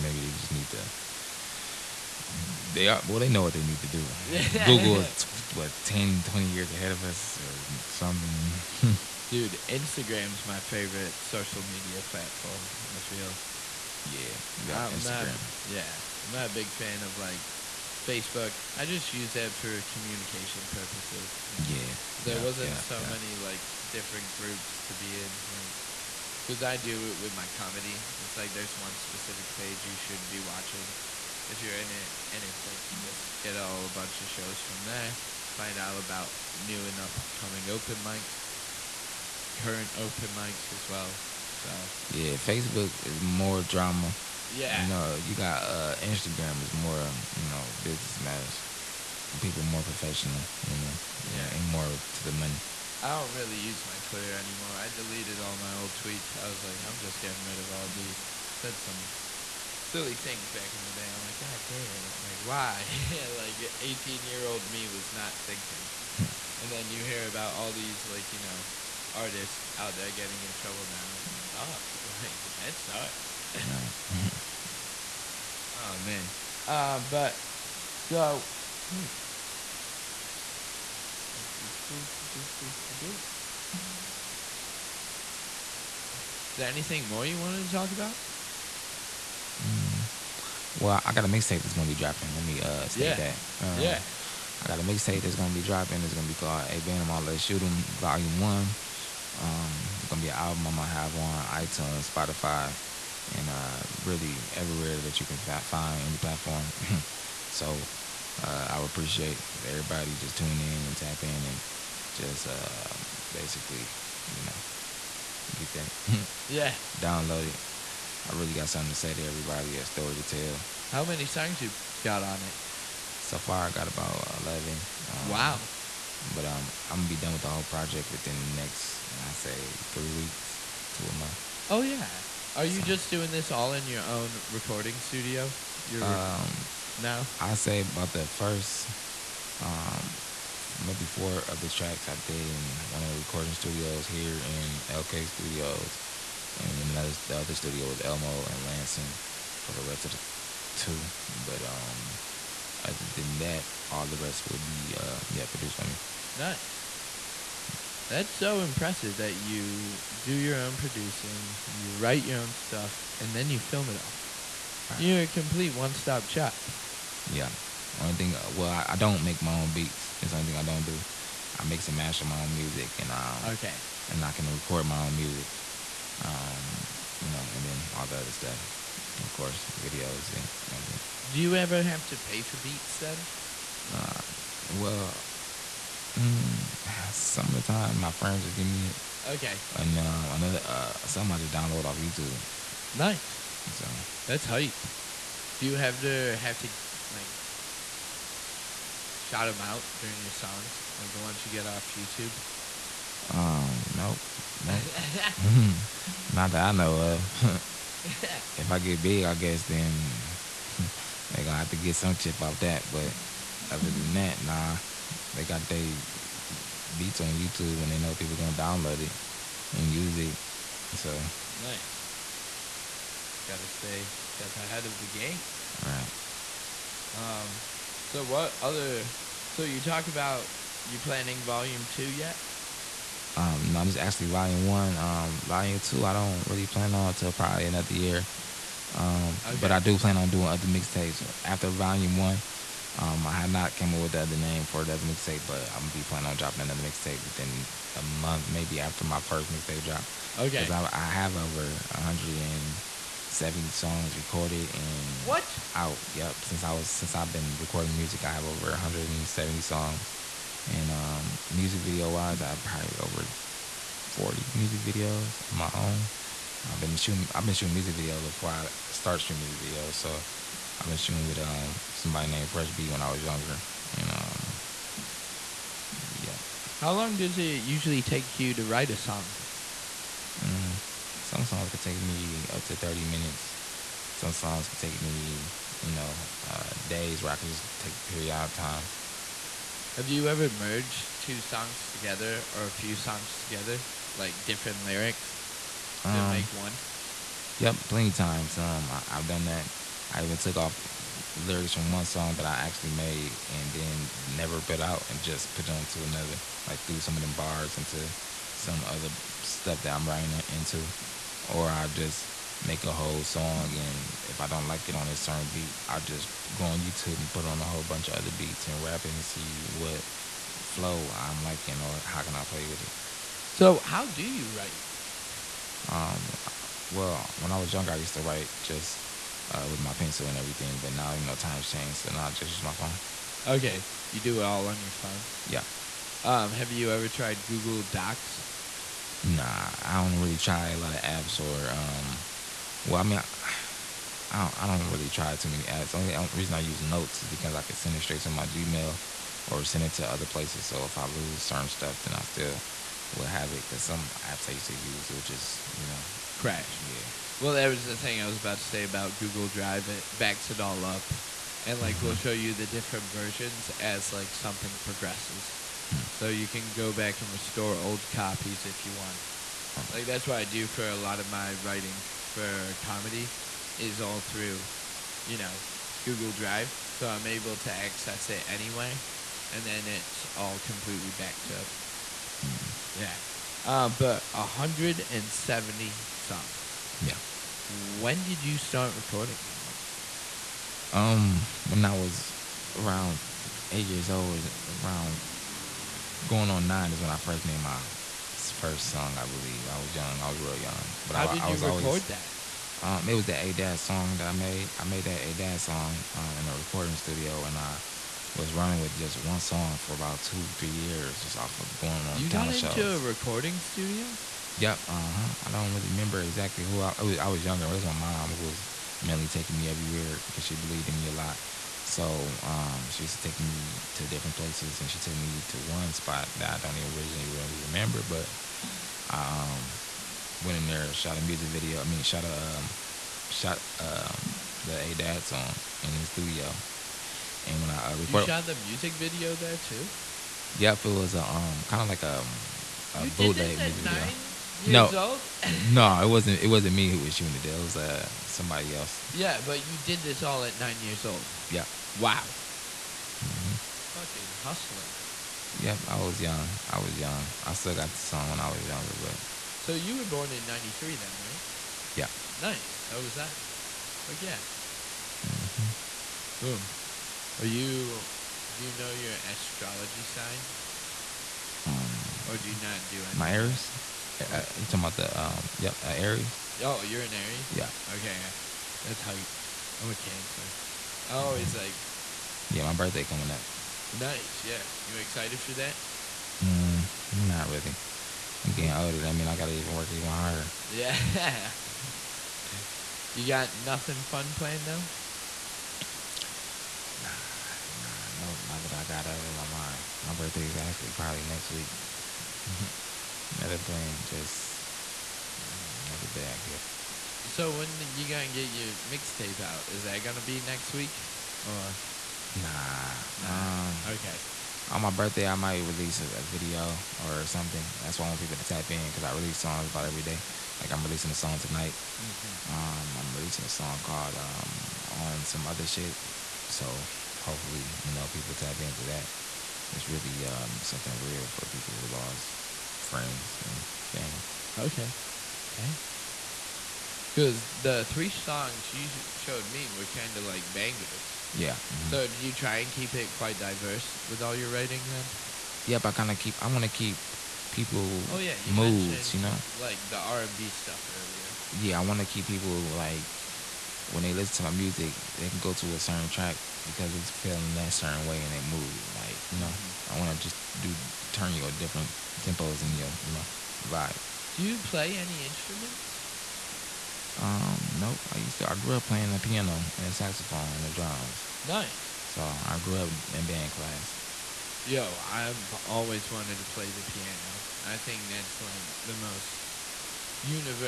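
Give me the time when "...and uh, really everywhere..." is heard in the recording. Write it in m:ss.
1:43.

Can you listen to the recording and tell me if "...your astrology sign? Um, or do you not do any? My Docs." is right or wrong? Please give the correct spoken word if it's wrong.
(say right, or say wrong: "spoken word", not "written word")
wrong: "Aries", not "Docs".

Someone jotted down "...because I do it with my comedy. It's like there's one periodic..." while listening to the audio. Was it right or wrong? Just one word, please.
wrong.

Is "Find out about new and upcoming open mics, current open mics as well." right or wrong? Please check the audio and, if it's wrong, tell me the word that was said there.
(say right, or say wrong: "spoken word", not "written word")
right.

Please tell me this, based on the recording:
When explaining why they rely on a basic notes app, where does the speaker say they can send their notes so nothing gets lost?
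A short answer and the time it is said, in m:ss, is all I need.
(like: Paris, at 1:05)
Gmail, at 5:48.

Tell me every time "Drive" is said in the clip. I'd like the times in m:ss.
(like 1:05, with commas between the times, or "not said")
5:59, 6:16.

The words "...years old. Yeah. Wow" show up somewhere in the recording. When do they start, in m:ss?
7:30.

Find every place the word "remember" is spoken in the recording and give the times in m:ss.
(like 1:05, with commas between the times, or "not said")
6:55, 7:07.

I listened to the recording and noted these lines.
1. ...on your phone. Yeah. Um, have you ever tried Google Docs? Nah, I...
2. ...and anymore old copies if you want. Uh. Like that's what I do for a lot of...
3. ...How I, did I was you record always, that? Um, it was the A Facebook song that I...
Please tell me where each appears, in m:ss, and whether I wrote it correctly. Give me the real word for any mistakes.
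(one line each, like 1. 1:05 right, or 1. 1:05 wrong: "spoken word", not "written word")
1. 5:34 right
2. 6:07 wrong: "restore", not "anymore"
3. 6:41 wrong: "Dad", not "Facebook".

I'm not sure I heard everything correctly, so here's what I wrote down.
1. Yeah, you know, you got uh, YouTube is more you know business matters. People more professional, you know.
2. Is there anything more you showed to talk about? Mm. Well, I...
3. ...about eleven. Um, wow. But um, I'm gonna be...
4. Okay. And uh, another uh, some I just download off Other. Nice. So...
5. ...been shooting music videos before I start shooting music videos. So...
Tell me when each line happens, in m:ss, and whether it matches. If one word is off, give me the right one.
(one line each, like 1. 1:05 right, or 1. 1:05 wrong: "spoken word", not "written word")
1. 0:44 wrong: "Instagram", not "YouTube"
2. 1:26 wrong: "wanted", not "showed"
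3. 2:03 right
4. 3:09 wrong: "YouTube", not "Other"
5. 4:27 right.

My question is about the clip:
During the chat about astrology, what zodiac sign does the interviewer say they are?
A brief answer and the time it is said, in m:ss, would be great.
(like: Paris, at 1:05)
Cancer, at 7:59.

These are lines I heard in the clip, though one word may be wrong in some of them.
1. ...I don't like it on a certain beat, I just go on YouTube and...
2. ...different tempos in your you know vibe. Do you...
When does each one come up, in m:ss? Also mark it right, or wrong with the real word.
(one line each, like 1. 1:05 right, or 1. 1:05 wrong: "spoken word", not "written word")
1. 5:14 right
2. 9:21 right.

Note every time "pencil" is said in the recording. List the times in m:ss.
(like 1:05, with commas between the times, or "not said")
5:29.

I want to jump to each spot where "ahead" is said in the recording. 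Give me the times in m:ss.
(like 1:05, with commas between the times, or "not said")
0:06, 3:44.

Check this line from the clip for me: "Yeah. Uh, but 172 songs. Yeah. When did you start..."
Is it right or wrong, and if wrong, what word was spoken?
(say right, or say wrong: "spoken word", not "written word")
wrong: "170", not "172".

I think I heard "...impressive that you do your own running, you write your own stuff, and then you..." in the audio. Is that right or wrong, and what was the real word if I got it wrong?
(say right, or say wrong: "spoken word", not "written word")
wrong: "producing", not "running".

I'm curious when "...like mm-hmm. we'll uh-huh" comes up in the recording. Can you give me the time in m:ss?
6:01.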